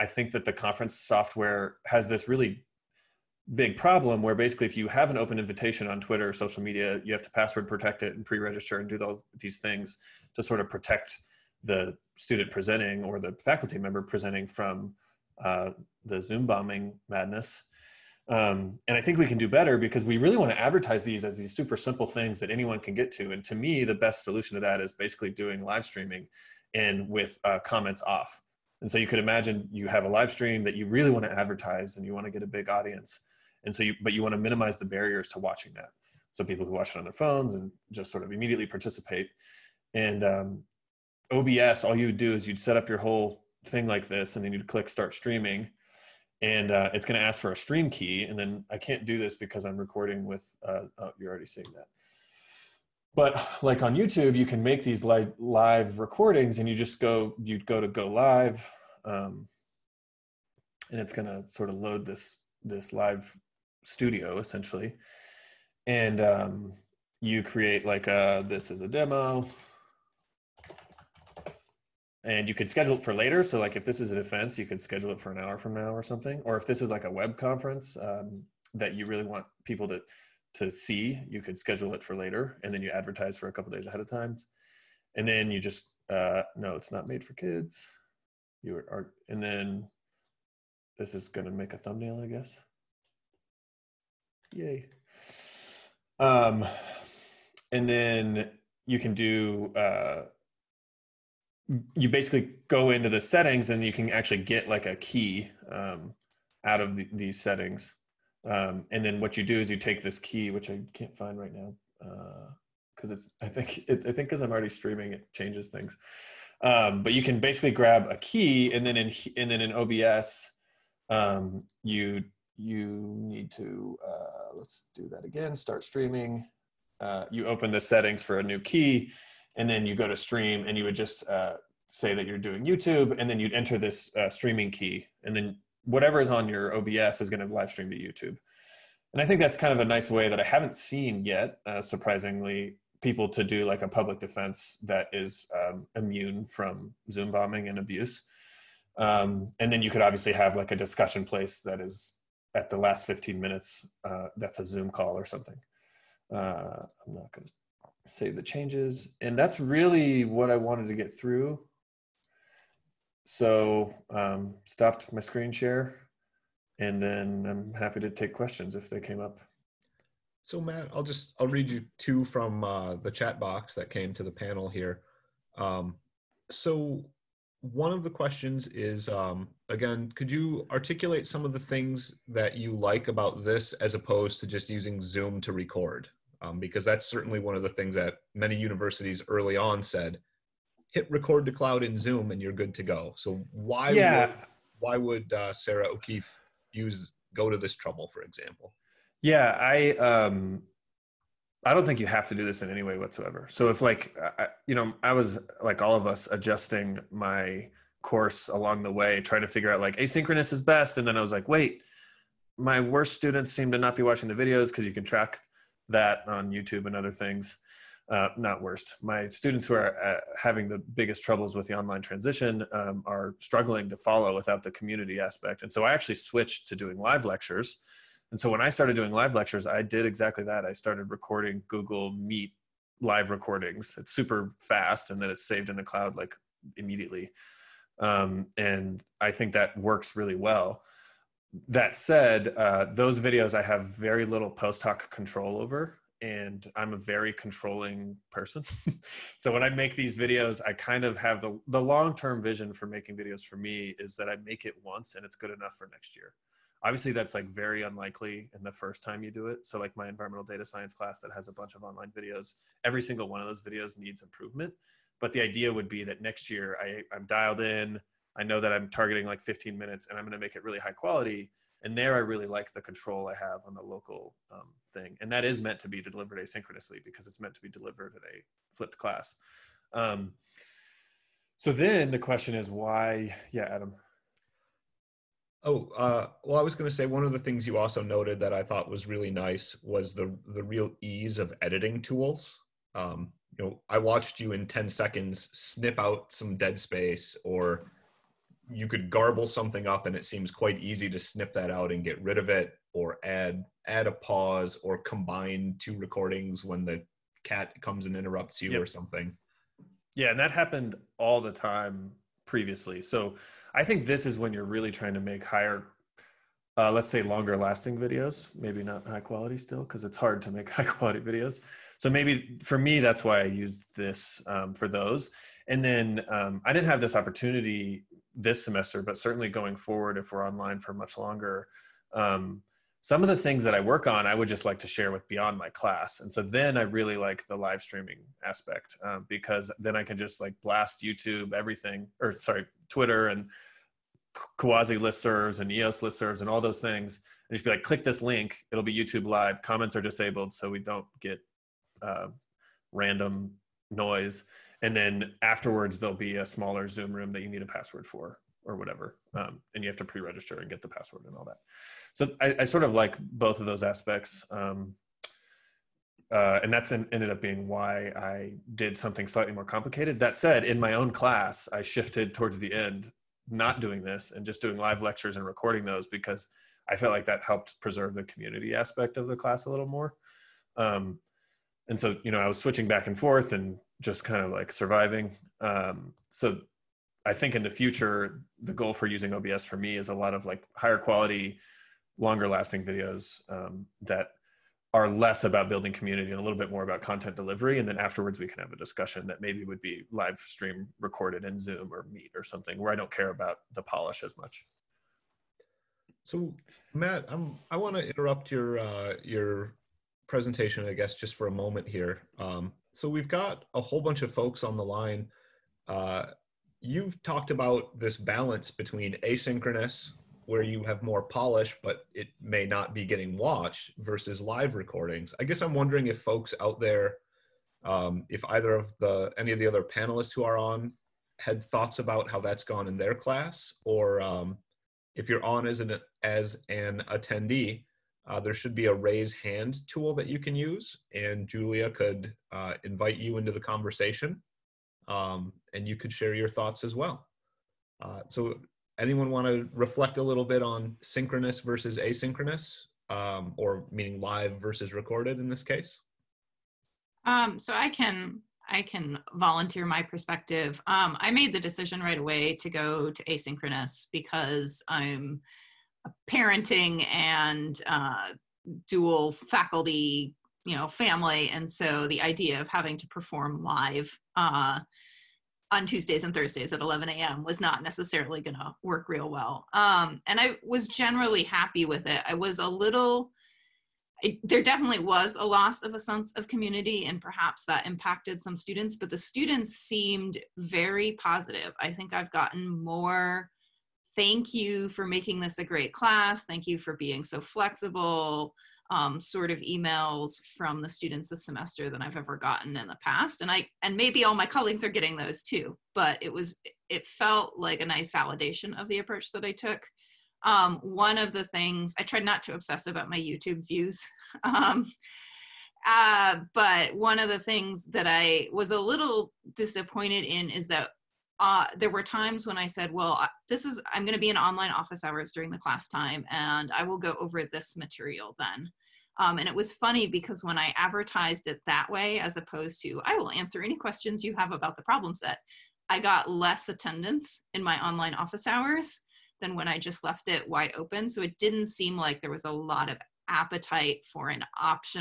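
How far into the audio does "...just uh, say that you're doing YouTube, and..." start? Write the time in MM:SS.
02:10.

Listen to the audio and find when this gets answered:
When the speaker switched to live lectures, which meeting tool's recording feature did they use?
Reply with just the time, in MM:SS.
03:51.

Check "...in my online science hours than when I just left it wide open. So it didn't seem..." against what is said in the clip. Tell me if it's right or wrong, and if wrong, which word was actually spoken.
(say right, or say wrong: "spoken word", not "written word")
wrong: "office", not "science".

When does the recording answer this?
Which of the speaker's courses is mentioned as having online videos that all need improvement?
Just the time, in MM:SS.
04:20.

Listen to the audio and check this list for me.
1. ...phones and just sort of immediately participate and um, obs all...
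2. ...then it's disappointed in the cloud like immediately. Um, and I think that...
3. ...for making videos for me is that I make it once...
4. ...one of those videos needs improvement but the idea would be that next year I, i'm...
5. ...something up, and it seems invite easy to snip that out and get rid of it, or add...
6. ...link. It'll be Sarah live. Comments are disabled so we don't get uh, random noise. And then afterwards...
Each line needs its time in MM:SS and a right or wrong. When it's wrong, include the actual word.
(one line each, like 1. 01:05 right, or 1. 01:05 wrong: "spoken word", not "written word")
1. 00:37 right
2. 03:55 wrong: "saved", not "disappointed"
3. 04:12 right
4. 04:23 right
5. 04:59 wrong: "quite", not "invite"
6. 05:48 wrong: "YouTube", not "Sarah".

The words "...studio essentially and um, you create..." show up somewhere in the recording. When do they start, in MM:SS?
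01:03.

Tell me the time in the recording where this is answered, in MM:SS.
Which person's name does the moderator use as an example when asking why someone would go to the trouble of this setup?
03:15.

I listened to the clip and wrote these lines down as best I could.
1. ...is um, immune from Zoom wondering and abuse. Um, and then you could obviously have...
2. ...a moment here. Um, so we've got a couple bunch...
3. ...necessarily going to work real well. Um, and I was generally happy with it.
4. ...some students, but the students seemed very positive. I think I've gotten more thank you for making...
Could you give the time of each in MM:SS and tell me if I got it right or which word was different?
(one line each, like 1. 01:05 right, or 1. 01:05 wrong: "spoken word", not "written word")
1. 02:25 wrong: "bombing", not "wondering"
2. 06:51 wrong: "whole", not "couple"
3. 07:57 right
4. 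08:08 right.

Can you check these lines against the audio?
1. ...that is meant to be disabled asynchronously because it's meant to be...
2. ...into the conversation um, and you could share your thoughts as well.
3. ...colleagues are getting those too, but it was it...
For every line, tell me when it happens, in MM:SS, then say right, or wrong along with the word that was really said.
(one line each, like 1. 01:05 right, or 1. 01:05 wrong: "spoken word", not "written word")
1. 04:35 wrong: "delivered", not "disabled"
2. 07:23 right
3. 08:24 right.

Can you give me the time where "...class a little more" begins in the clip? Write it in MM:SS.
06:19.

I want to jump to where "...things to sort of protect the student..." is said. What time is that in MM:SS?
00:09.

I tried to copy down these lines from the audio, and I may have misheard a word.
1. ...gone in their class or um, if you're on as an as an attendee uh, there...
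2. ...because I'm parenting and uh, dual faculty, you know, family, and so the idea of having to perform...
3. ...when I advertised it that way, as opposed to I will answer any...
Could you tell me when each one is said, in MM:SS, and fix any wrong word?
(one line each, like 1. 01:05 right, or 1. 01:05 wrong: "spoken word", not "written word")
1. 07:12 right
2. 07:44 right
3. 08:50 right.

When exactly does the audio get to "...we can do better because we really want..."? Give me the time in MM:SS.
00:19.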